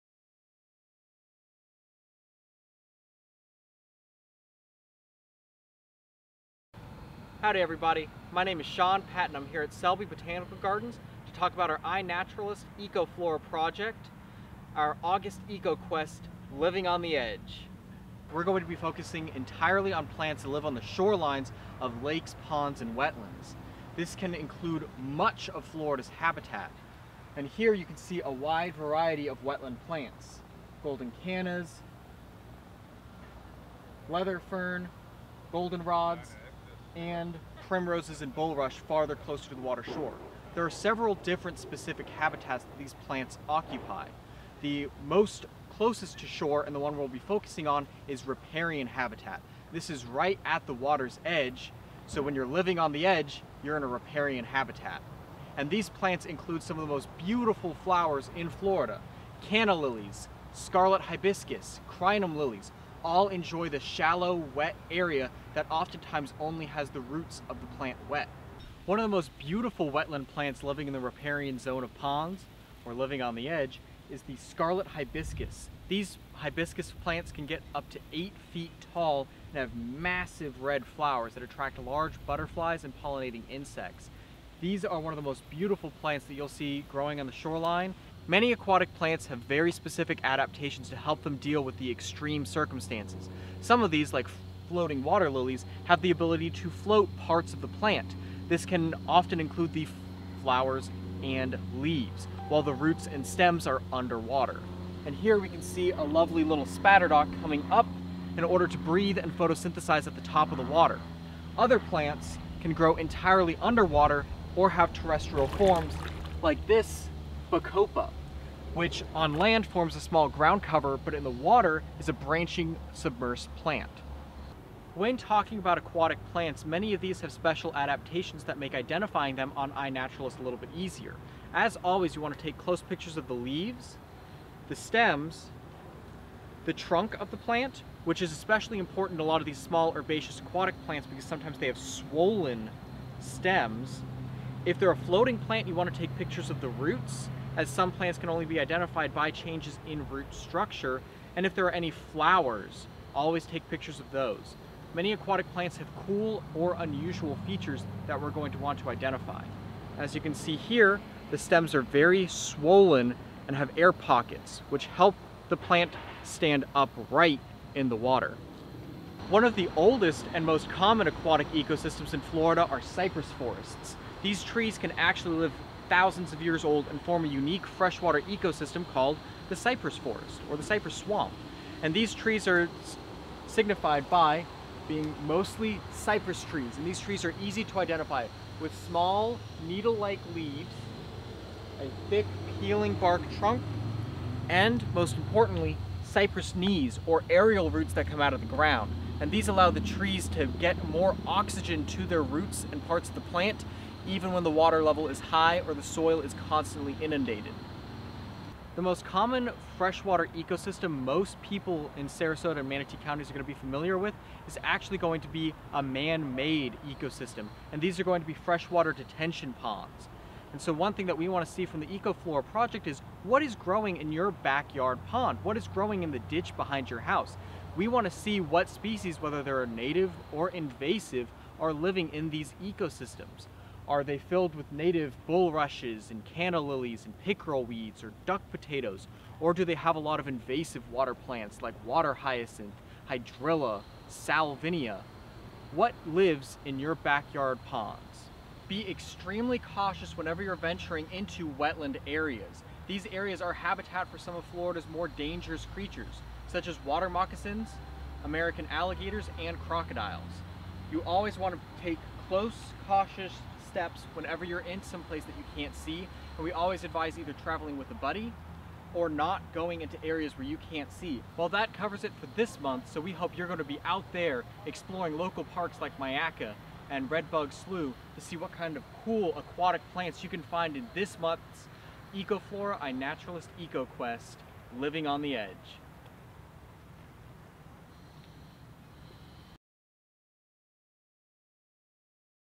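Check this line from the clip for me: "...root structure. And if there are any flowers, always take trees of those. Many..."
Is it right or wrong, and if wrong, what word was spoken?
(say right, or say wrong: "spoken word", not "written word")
wrong: "pictures", not "trees".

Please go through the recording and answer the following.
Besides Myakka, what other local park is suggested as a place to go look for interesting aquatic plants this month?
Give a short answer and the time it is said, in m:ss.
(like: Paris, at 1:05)
Redbug Slough, at 4:37.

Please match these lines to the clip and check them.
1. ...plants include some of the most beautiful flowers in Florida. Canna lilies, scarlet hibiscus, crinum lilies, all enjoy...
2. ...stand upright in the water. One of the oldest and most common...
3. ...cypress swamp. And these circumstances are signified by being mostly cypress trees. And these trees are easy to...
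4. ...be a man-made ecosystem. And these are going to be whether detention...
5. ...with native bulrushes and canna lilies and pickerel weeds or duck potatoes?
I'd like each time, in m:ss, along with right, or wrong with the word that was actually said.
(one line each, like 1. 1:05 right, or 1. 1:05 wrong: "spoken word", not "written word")
1. 0:55 right
2. 2:46 right
3. 3:00 wrong: "trees", not "circumstances"
4. 3:35 wrong: "freshwater", not "whether"
5. 3:54 right.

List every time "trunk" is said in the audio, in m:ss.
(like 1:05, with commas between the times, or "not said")
2:16, 3:13.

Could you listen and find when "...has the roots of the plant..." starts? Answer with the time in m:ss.
1:06.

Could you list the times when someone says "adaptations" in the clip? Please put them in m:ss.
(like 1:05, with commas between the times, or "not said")
1:30, 2:07.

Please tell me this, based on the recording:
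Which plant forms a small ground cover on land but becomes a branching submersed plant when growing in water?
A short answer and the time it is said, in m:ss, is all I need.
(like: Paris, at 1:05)
Bacopa, at 1:57.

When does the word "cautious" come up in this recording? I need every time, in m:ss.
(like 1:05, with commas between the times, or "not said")
4:09, 4:22.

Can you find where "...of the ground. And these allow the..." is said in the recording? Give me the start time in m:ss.
3:18.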